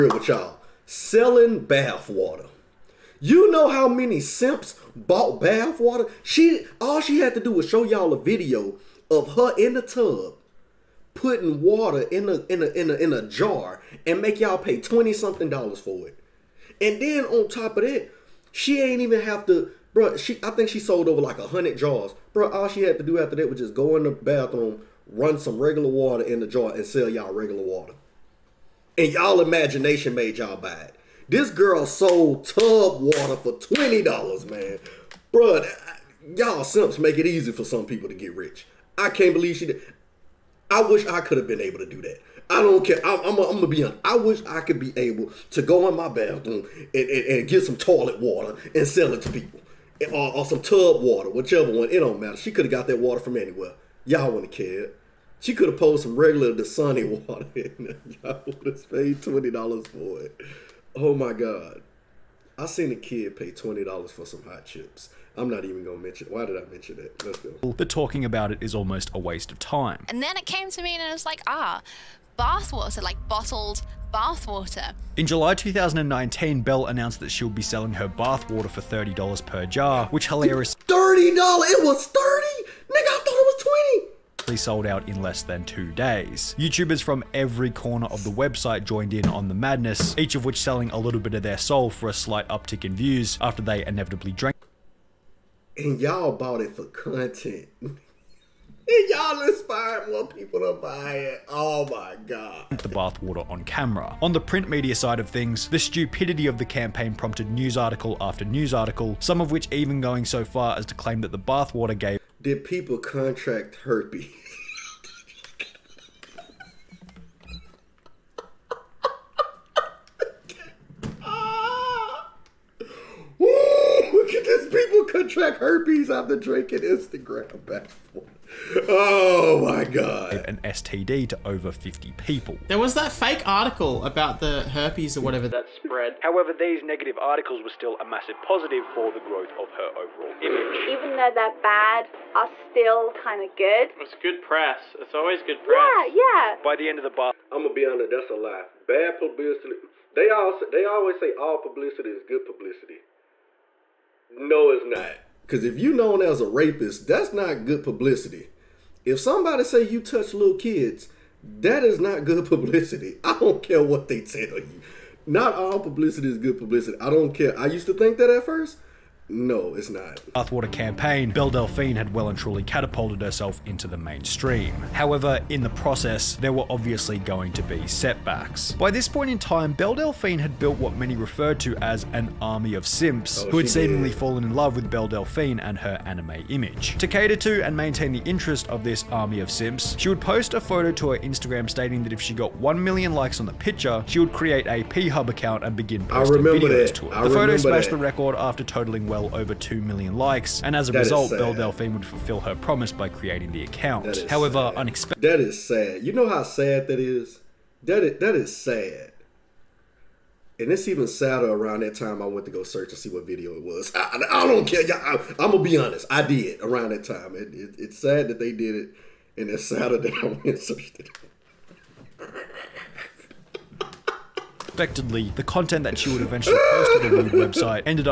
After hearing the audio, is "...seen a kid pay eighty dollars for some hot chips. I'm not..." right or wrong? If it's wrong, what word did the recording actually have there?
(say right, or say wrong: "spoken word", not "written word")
wrong: "twenty", not "eighty".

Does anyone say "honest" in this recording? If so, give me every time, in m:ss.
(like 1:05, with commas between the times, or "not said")
0:43, 2:27, 3:35.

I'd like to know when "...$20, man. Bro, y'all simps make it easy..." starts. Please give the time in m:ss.
0:33.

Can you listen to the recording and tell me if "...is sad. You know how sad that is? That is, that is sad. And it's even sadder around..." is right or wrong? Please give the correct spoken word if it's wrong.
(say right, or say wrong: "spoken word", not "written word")
right.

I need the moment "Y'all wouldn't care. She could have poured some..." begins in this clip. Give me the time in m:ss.
0:54.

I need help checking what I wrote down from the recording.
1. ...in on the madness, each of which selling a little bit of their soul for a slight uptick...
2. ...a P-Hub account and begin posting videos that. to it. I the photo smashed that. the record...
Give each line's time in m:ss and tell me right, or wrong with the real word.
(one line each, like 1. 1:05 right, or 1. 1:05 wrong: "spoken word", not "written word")
1. 1:29 right
2. 3:14 right.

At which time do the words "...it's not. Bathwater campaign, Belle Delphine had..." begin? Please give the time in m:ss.
2:49.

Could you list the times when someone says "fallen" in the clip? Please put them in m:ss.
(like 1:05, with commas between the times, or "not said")
3:04.